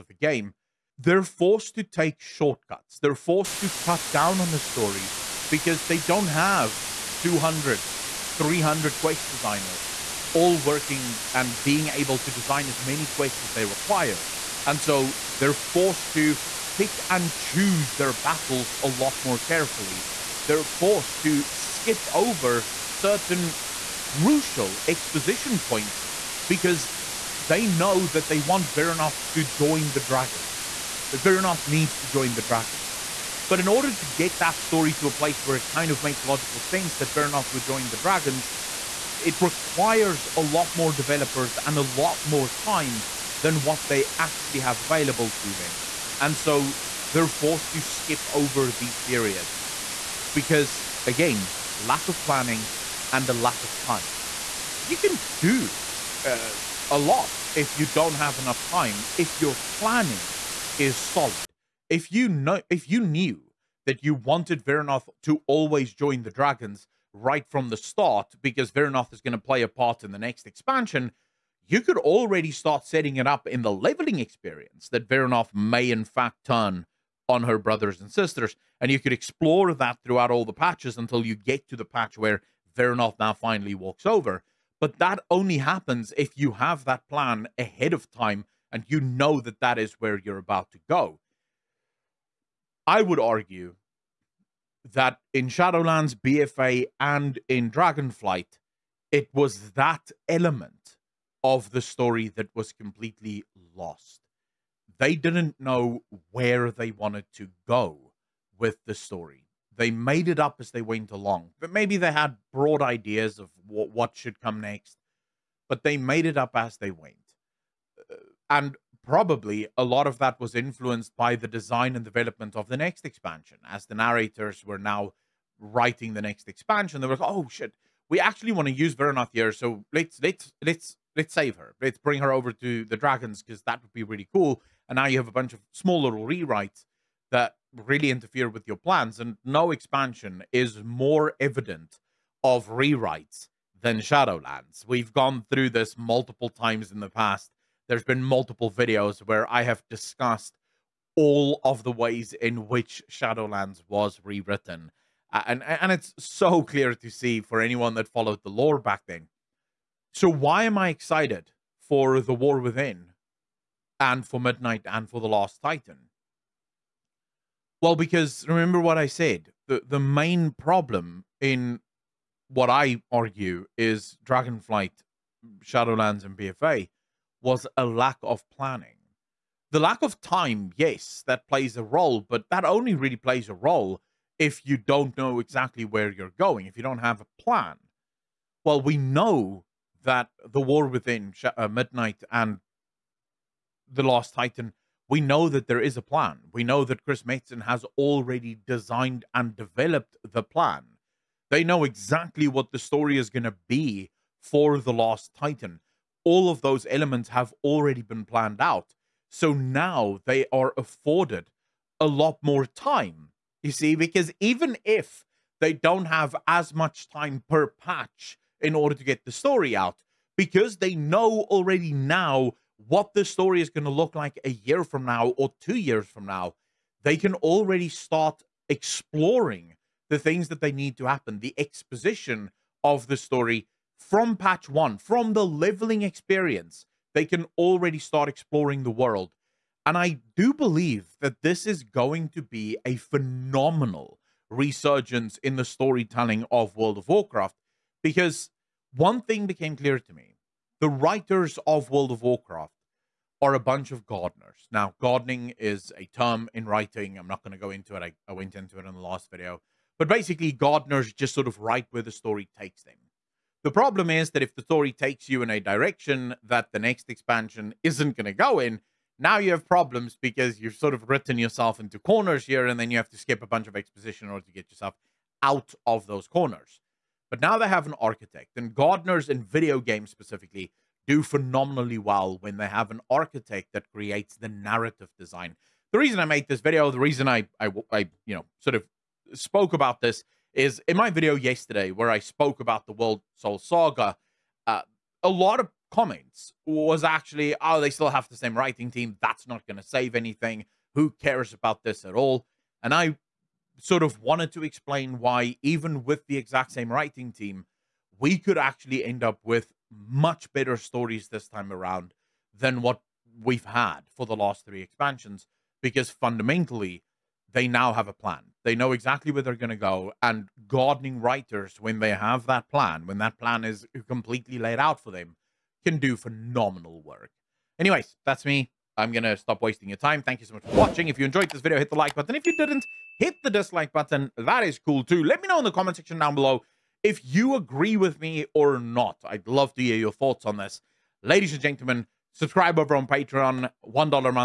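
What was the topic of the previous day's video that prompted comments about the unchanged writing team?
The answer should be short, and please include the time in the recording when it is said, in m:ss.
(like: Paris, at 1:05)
World Soul Saga, at 4:52.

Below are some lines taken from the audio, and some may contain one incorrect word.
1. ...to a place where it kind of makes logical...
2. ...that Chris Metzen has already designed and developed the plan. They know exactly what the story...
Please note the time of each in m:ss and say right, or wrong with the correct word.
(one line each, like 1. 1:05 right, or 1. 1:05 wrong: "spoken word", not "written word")
1. 0:34 right
2. 3:16 right.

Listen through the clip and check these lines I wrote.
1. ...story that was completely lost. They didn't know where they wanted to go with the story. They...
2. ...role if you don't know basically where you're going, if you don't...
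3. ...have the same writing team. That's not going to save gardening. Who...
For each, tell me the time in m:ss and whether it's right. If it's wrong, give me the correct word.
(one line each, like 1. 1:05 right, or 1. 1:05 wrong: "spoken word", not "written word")
1. 1:41 right
2. 3:03 wrong: "exactly", not "basically"
3. 4:58 wrong: "anything", not "gardening".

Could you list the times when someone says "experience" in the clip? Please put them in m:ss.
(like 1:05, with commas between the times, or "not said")
1:14, 3:56.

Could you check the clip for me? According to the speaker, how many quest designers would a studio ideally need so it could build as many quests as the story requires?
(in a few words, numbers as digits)
200, 300.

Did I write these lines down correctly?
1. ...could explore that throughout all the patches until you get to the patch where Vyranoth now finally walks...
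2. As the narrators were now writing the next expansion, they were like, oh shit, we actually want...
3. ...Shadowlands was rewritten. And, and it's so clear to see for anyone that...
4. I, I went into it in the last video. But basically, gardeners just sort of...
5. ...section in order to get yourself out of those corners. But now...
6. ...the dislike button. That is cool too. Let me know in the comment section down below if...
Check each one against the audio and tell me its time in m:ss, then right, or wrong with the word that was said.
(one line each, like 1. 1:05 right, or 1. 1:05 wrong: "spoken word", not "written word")
1. 1:18 right
2. 2:03 right
3. 2:33 right
4. 4:18 right
5. 4:33 wrong: "exposition", not "section"
6. 5:33 right.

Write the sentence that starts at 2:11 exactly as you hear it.
Let's bring her over to the dragons because that would be really cool.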